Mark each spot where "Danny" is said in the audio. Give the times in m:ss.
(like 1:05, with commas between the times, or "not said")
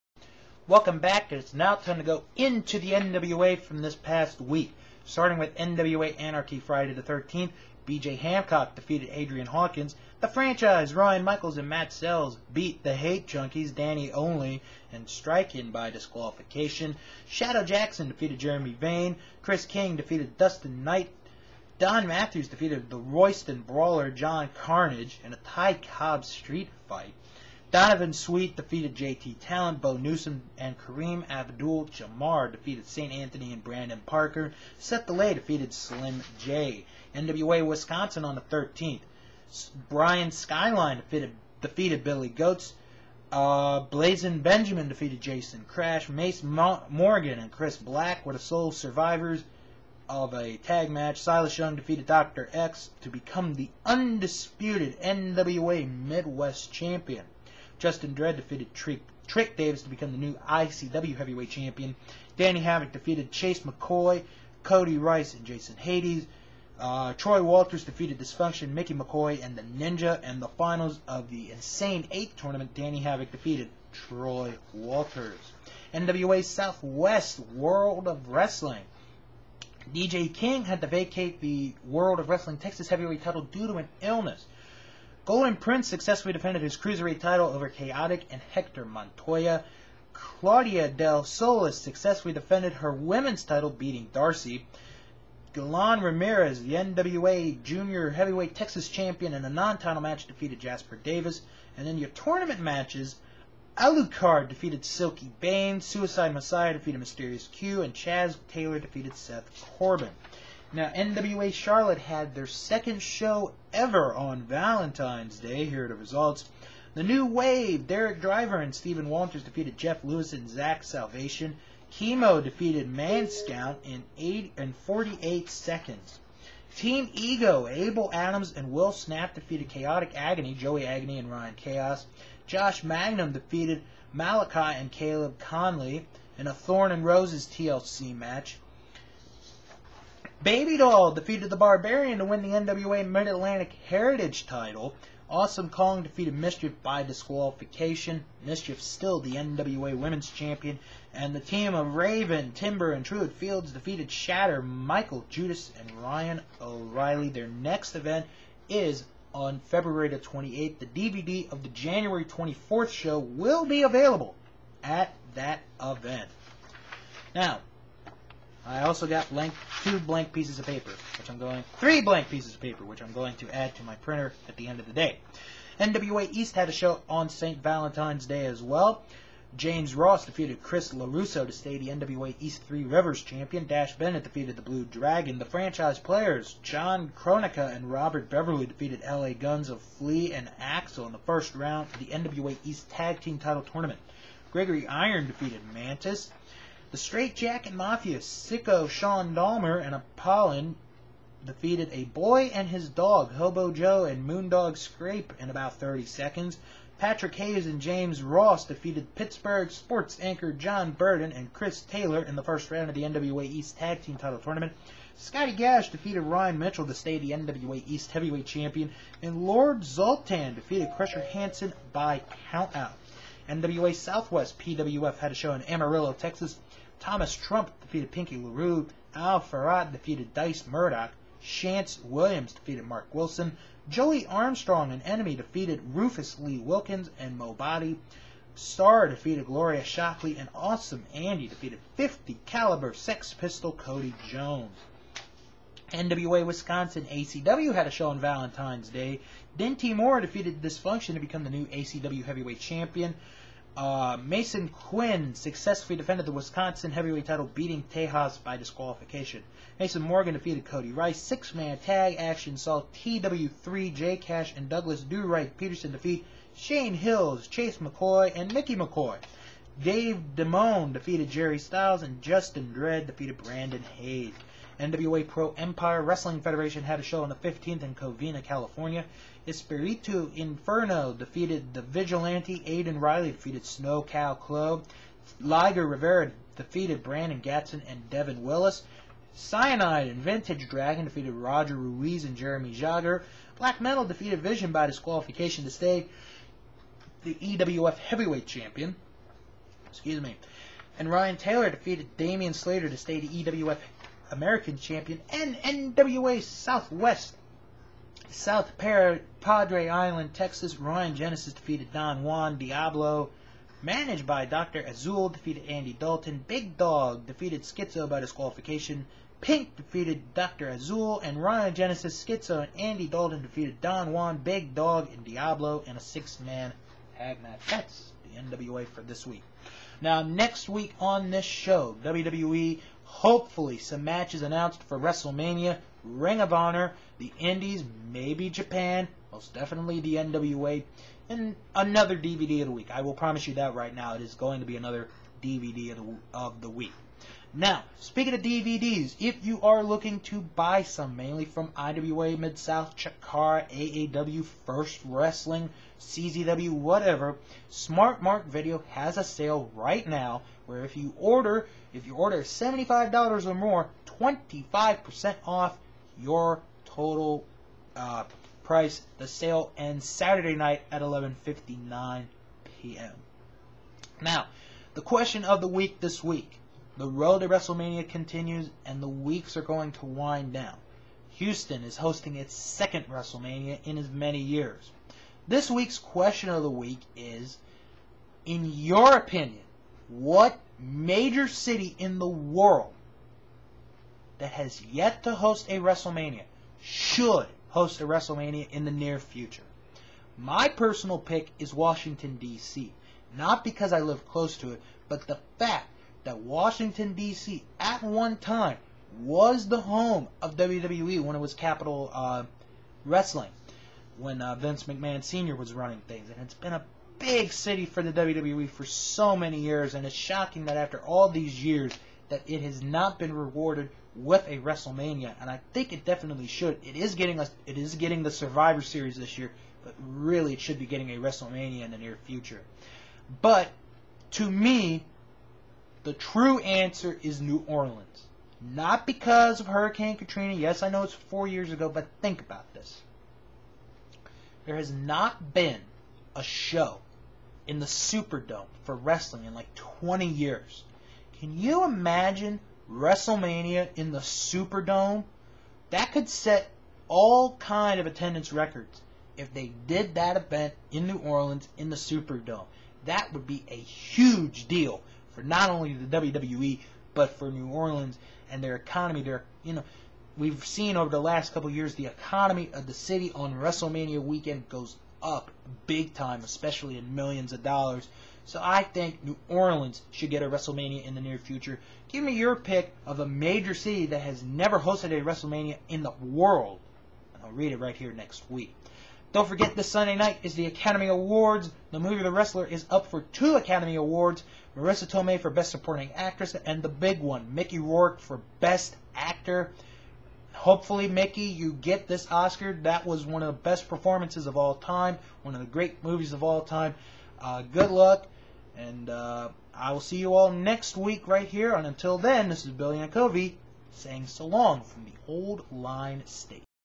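0:13, 1:02, 1:12.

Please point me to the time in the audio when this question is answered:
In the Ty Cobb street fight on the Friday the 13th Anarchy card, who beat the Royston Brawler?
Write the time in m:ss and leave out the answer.
0:21.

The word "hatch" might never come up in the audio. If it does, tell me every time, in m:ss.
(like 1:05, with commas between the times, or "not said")
not said.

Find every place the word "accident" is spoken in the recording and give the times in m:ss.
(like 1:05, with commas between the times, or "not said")
not said.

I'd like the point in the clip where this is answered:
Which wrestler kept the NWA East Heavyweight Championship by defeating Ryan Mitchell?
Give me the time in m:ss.
3:35.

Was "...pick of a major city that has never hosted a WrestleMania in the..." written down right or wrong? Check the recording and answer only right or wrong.
right.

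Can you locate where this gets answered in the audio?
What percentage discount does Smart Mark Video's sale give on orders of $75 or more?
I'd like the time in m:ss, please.
6:04.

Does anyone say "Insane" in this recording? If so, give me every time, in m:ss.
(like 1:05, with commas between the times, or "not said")
1:11.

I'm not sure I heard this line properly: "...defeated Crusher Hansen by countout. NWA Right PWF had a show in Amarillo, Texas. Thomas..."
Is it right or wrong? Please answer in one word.
wrong.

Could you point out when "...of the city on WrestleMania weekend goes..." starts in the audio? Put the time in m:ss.
7:52.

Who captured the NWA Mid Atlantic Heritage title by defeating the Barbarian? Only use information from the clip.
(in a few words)
Baby Doll.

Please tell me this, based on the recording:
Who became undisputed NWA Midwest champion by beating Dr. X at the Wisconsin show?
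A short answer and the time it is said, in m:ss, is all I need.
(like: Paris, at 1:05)
Silas Young, at 0:51.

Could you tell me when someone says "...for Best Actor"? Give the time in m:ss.
8:18.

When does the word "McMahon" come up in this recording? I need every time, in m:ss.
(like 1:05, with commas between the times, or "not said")
6:54.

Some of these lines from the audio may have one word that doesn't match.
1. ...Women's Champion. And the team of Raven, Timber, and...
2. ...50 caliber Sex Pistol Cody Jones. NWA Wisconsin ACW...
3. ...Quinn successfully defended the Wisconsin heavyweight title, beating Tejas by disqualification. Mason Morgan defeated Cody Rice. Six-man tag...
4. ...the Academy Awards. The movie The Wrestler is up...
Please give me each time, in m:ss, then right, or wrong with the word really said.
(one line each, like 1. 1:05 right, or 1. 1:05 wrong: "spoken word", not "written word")
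1. 2:29 right
2. 4:01 right
3. 4:14 right
4. 8:10 right.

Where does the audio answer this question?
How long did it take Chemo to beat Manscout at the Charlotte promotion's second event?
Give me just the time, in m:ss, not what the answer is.
2:04.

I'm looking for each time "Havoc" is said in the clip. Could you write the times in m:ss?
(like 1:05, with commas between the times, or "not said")
1:02, 1:12.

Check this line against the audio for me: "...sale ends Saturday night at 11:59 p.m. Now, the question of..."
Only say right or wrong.
right.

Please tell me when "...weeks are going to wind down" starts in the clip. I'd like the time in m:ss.
6:19.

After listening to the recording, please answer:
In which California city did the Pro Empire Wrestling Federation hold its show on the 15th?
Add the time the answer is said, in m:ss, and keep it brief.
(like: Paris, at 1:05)
Covina, at 4:37.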